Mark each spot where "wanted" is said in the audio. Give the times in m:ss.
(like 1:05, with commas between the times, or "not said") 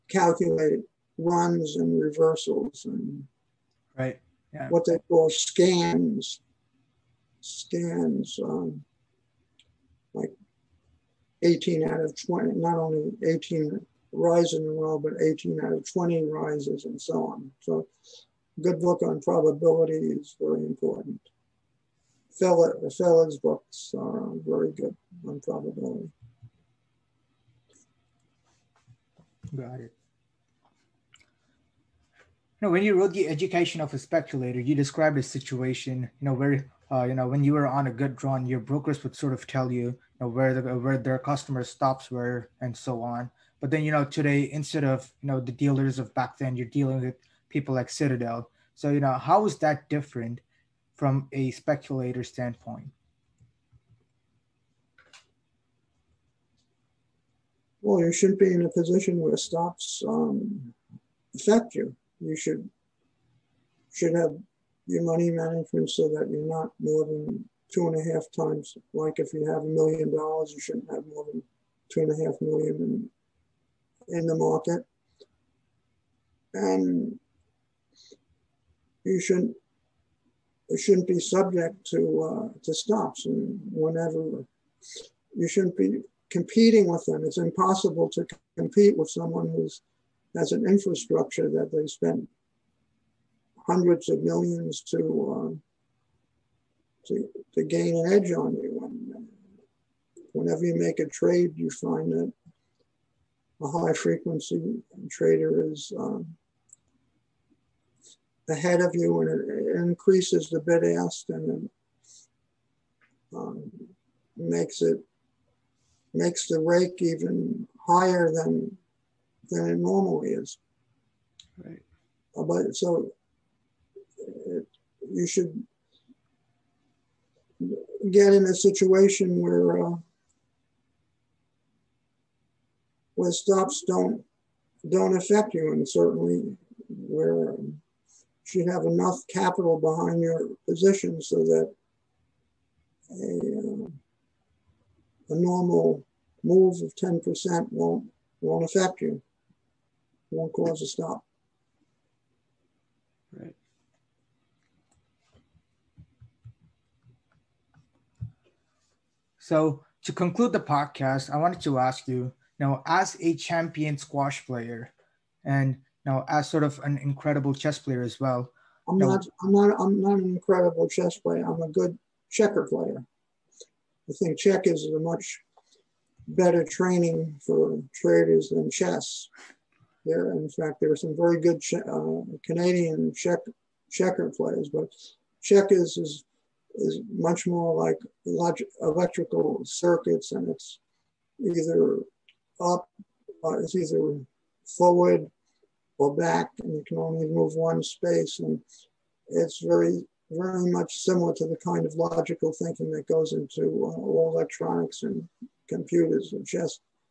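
2:41.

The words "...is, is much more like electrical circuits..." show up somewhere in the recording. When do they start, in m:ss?
3:05.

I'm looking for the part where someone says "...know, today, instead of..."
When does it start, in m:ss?
0:43.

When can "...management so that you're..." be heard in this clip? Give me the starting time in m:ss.
1:05.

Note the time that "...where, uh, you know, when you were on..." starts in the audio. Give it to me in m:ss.
0:36.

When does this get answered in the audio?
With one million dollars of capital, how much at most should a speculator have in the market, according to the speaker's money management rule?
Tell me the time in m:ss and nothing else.
1:11.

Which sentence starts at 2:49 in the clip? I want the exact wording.
I'm not an incredible chess player.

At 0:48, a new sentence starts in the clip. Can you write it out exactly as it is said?
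So, you know, how is that different from a speculator standpoint?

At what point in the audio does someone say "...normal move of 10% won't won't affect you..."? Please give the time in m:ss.
2:25.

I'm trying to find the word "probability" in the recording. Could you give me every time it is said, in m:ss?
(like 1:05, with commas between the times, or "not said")
0:19, 0:25.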